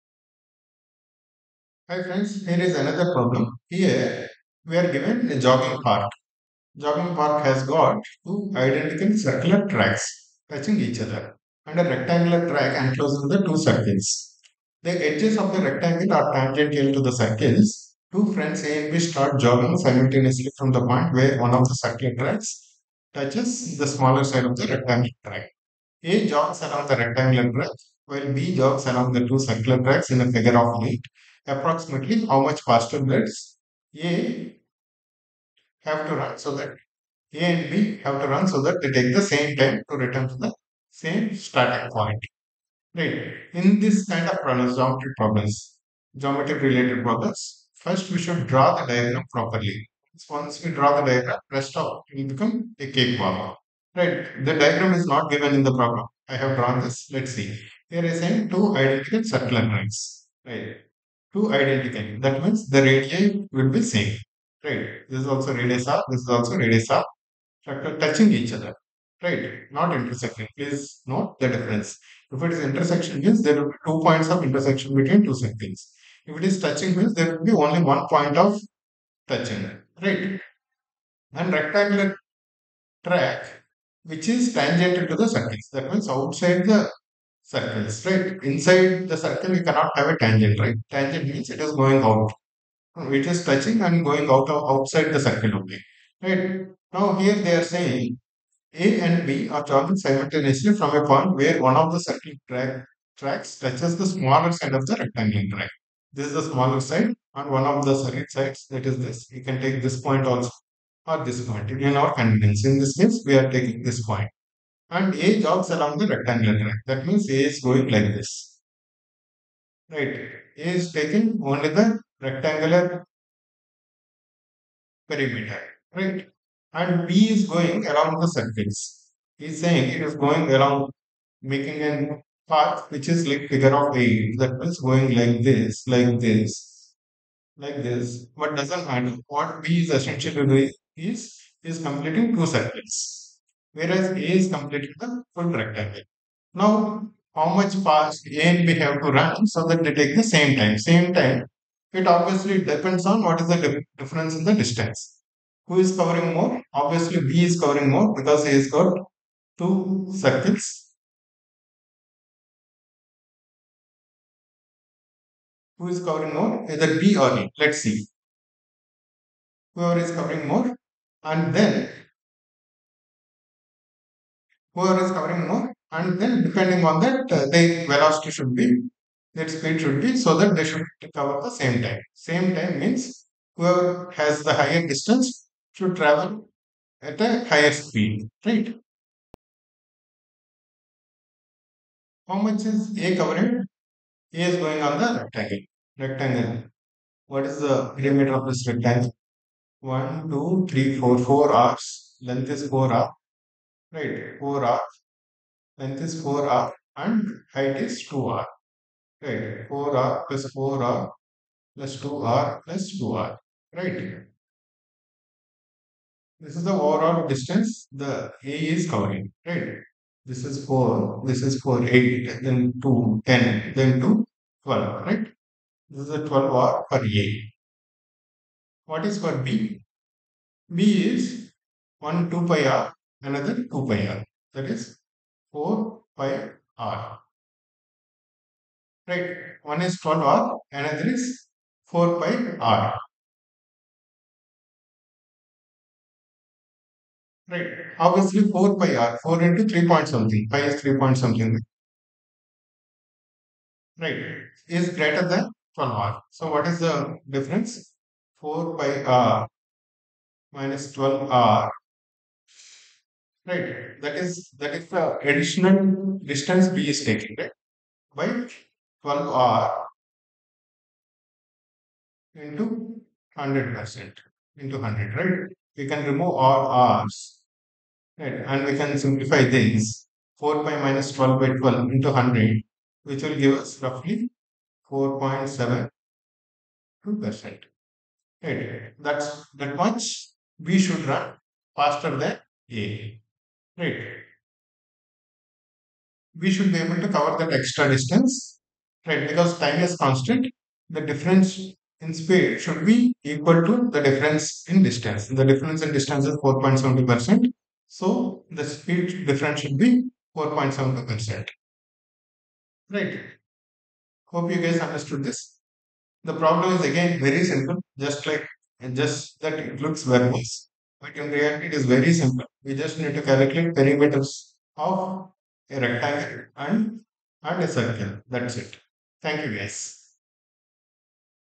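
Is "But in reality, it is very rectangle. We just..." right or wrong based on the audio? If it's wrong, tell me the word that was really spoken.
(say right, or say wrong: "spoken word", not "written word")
wrong: "simple", not "rectangle".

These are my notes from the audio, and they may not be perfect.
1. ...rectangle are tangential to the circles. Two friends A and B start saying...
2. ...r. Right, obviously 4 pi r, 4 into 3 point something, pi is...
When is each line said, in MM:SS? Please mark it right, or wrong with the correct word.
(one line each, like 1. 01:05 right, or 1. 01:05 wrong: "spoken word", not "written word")
1. 00:15 wrong: "jogging", not "saying"
2. 04:02 right.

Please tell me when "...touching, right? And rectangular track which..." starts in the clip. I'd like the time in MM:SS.
01:19.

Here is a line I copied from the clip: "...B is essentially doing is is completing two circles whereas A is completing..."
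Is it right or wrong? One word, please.
right.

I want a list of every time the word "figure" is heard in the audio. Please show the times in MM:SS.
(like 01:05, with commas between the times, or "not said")
00:30, 02:13.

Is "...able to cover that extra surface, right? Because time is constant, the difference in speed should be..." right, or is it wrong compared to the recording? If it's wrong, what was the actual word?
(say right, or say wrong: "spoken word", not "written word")
wrong: "distance", not "surface".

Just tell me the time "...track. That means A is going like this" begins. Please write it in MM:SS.
01:56.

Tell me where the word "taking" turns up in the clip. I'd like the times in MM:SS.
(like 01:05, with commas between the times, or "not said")
01:53, 02:00, 04:27.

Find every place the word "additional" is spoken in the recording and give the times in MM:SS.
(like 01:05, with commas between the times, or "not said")
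04:25.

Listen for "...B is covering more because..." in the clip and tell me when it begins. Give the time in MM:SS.
02:37.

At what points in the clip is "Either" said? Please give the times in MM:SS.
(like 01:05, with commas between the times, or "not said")
02:46.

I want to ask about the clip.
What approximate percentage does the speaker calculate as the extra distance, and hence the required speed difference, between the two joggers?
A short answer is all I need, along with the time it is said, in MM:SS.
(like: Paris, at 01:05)
4.72%, at 04:44.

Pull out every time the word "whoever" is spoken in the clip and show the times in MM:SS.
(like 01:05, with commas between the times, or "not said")
02:49, 02:54, 03:03.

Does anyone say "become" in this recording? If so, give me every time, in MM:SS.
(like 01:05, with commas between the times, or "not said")
00:52.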